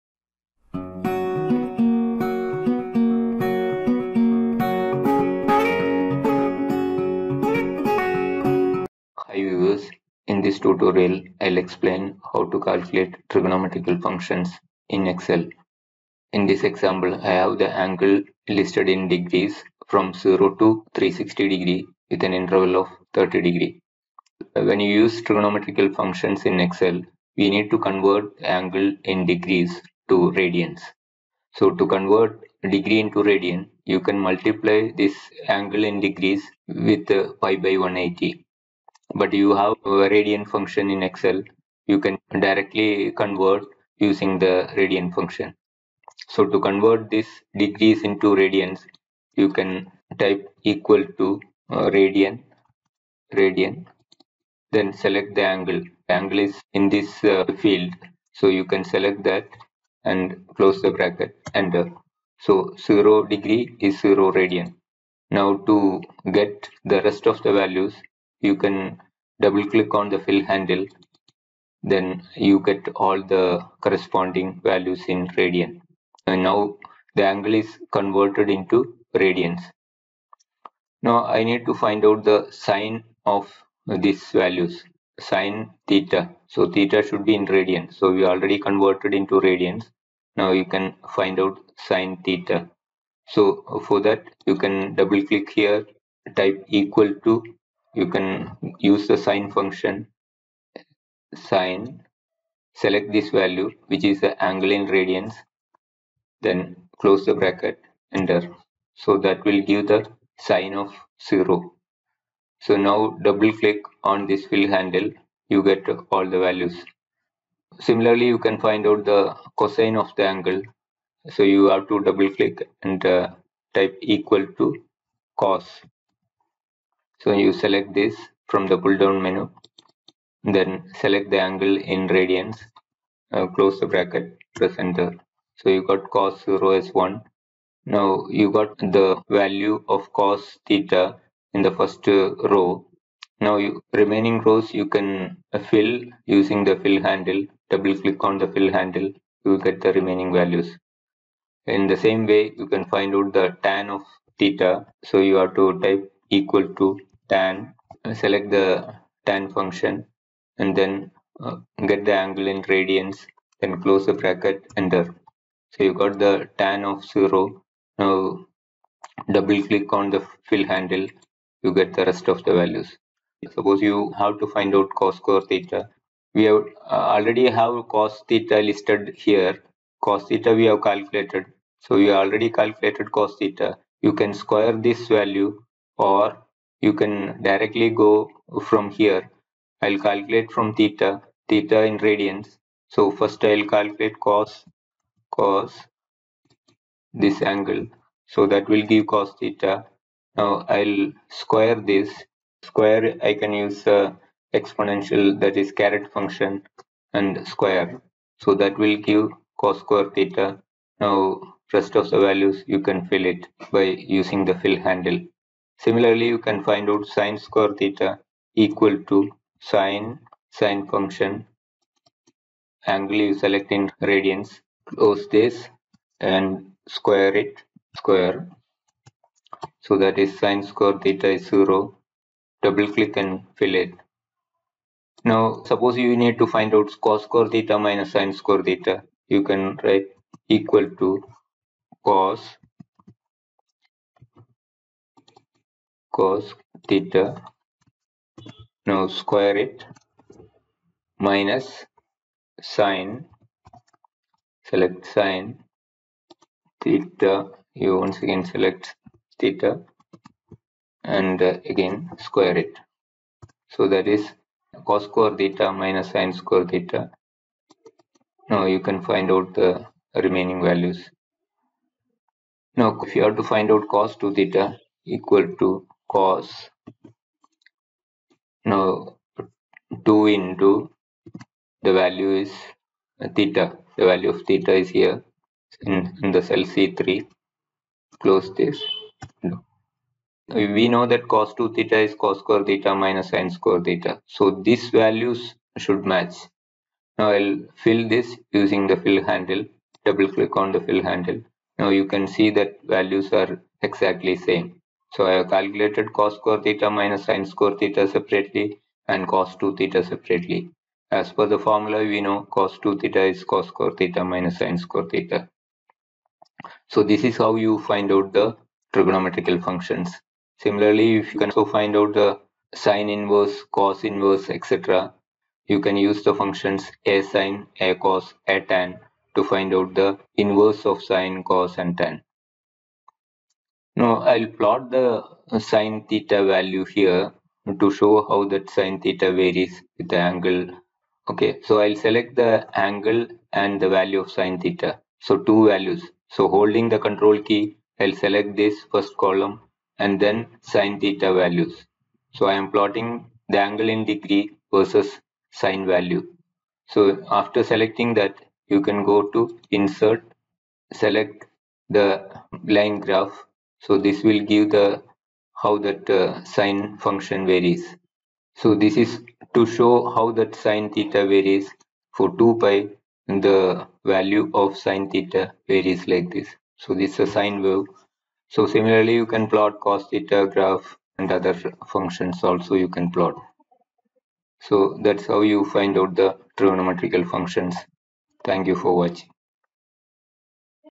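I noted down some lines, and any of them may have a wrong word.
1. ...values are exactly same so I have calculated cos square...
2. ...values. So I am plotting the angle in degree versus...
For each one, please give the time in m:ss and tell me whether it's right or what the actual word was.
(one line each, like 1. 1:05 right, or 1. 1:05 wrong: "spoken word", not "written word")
1. 5:02 right
2. 5:51 right.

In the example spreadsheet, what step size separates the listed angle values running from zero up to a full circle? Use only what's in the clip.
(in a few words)
30 degree.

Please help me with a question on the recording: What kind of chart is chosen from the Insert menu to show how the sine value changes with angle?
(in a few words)
line graph.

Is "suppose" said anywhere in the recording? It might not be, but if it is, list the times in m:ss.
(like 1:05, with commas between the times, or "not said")
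2:53, 3:55.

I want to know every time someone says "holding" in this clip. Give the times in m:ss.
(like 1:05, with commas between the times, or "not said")
5:46.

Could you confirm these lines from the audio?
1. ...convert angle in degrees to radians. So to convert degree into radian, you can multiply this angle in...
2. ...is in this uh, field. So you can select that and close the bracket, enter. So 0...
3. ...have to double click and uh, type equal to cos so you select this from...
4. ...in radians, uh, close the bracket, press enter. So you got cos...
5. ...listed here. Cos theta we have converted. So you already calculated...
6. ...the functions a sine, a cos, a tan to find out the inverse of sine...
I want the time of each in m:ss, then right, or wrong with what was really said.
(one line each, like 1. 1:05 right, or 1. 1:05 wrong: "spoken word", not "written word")
1. 0:27 right
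2. 0:56 right
3. 2:01 right
4. 2:11 right
5. 2:58 wrong: "calculated", not "converted"
6. 5:26 right.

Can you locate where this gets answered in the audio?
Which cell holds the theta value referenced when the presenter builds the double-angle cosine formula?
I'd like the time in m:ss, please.
4:46.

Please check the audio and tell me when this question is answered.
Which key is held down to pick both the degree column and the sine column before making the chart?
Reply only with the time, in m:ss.
5:46.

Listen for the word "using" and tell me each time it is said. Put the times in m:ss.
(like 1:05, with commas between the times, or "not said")
0:43, 2:26, 3:34, 4:58.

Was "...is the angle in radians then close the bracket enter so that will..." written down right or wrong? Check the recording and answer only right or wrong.
right.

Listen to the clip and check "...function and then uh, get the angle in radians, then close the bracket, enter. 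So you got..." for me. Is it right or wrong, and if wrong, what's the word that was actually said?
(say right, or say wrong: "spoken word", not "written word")
right.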